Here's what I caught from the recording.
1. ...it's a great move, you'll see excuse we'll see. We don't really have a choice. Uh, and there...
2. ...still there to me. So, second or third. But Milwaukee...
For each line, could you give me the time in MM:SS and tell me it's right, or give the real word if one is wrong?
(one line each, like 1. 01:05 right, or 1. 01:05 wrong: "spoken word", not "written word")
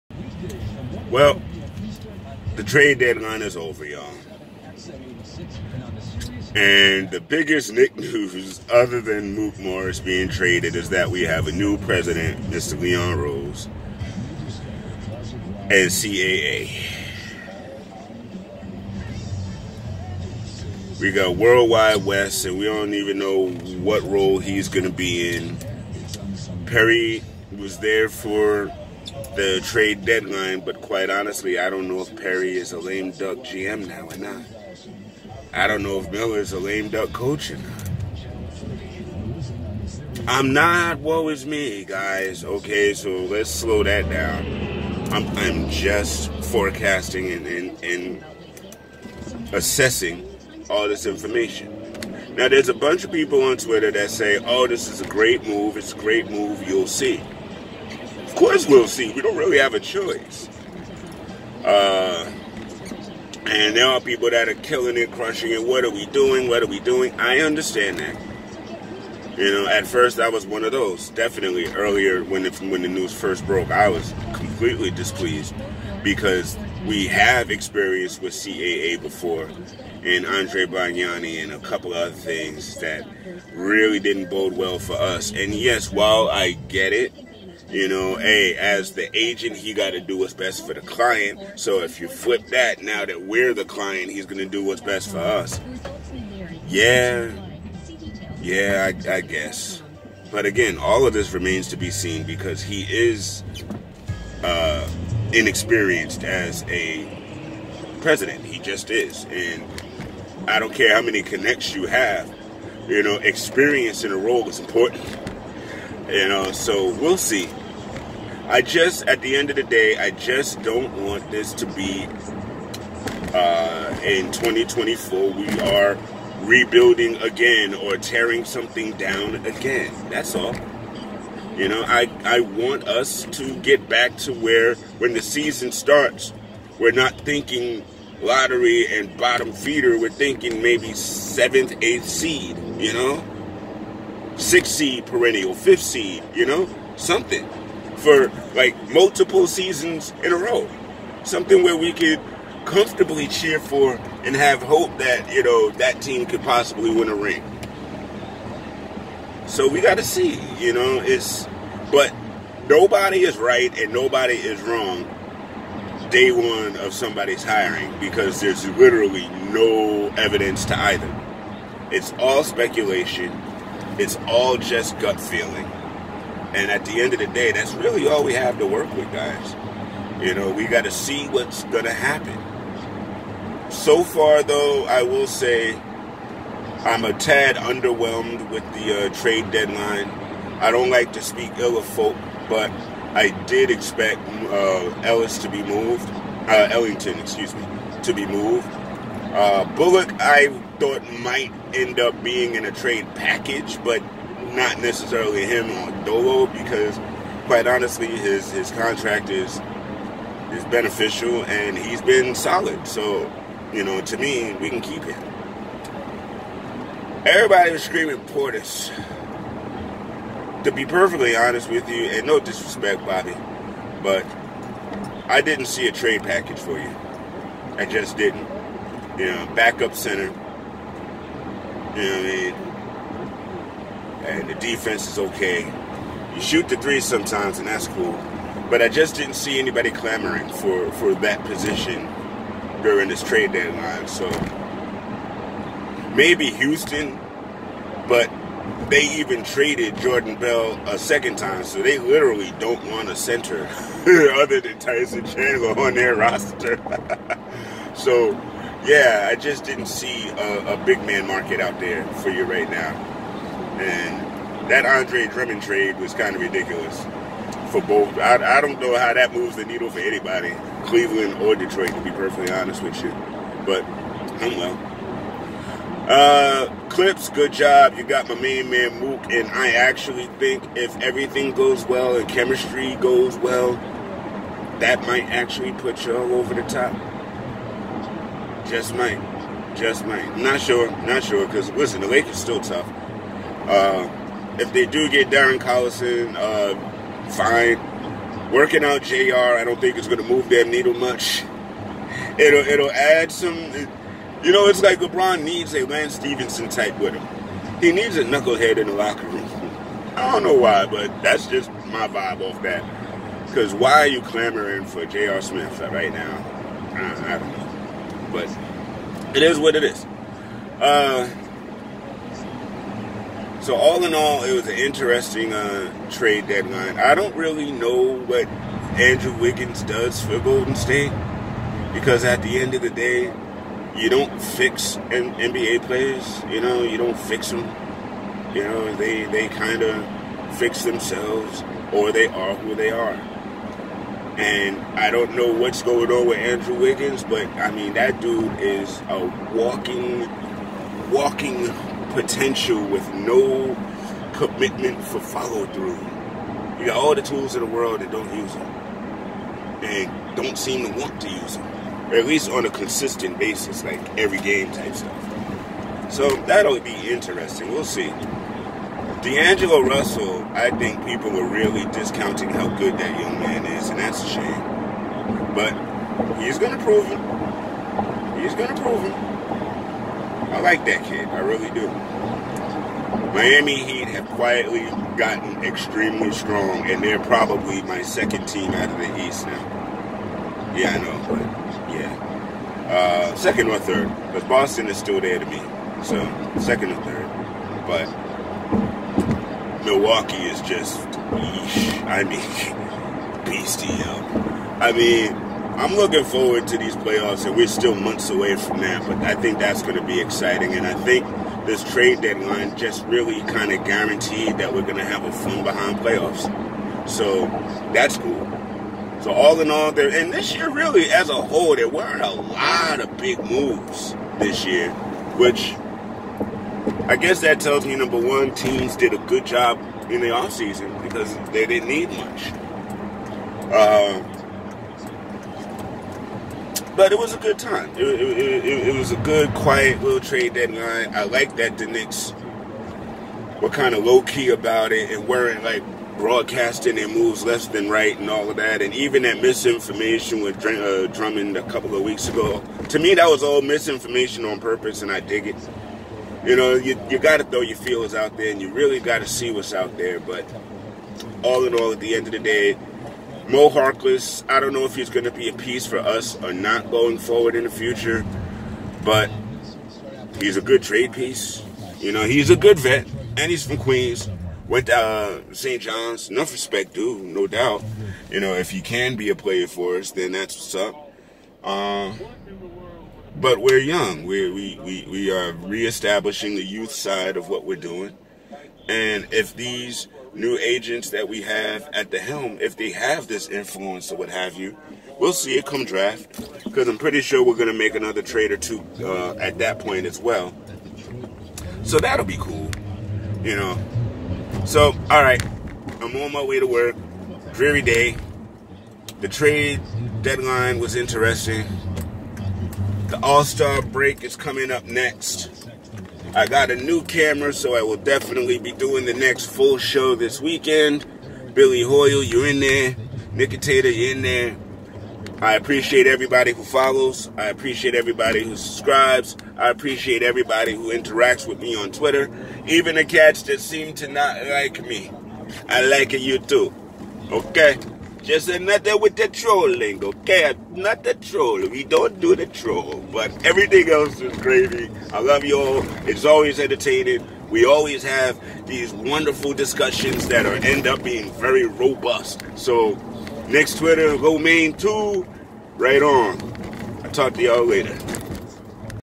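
1. 00:55 wrong: "course", not "excuse"
2. 06:34 right.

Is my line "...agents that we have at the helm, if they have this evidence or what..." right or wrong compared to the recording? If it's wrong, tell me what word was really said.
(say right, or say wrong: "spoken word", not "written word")
wrong: "influence", not "evidence".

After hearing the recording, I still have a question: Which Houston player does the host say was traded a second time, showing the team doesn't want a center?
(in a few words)
Jordan Bell.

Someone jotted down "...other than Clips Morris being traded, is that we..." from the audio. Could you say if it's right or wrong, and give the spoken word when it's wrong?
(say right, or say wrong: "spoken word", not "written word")
wrong: "Mook", not "Clips".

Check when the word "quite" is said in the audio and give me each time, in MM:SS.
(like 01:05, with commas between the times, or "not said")
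00:30, 03:27.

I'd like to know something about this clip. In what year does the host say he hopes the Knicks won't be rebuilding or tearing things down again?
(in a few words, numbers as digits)
2024.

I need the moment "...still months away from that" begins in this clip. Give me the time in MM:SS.
06:47.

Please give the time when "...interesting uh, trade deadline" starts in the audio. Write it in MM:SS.
05:24.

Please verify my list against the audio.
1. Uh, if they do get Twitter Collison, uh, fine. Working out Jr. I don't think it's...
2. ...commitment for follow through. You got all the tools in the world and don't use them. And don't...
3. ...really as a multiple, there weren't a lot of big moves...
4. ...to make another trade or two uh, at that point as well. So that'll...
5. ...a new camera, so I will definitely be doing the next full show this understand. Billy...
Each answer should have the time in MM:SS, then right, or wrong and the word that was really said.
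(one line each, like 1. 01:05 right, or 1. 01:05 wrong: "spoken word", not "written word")
1. 04:53 wrong: "Darren", not "Twitter"
2. 05:54 right
3. 07:00 wrong: "whole", not "multiple"
4. 08:17 right
5. 08:36 wrong: "weekend", not "understand".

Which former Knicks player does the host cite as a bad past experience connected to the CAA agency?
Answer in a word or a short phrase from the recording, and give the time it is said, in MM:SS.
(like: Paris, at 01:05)
Andrea Bargnani, at 01:20.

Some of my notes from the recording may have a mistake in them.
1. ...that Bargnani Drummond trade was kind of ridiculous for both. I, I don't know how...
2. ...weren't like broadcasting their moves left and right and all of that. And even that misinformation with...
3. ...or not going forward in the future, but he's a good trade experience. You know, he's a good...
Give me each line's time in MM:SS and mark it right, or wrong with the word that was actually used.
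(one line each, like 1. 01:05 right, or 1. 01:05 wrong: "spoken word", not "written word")
1. 04:24 wrong: "Andre", not "Bargnani"
2. 07:25 right
3. 07:46 wrong: "piece", not "experience".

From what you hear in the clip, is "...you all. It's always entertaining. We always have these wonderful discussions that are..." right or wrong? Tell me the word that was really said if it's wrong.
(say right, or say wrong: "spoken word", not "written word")
right.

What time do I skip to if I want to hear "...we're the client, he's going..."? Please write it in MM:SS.
01:33.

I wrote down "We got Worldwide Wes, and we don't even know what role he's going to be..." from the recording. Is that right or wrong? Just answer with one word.
right.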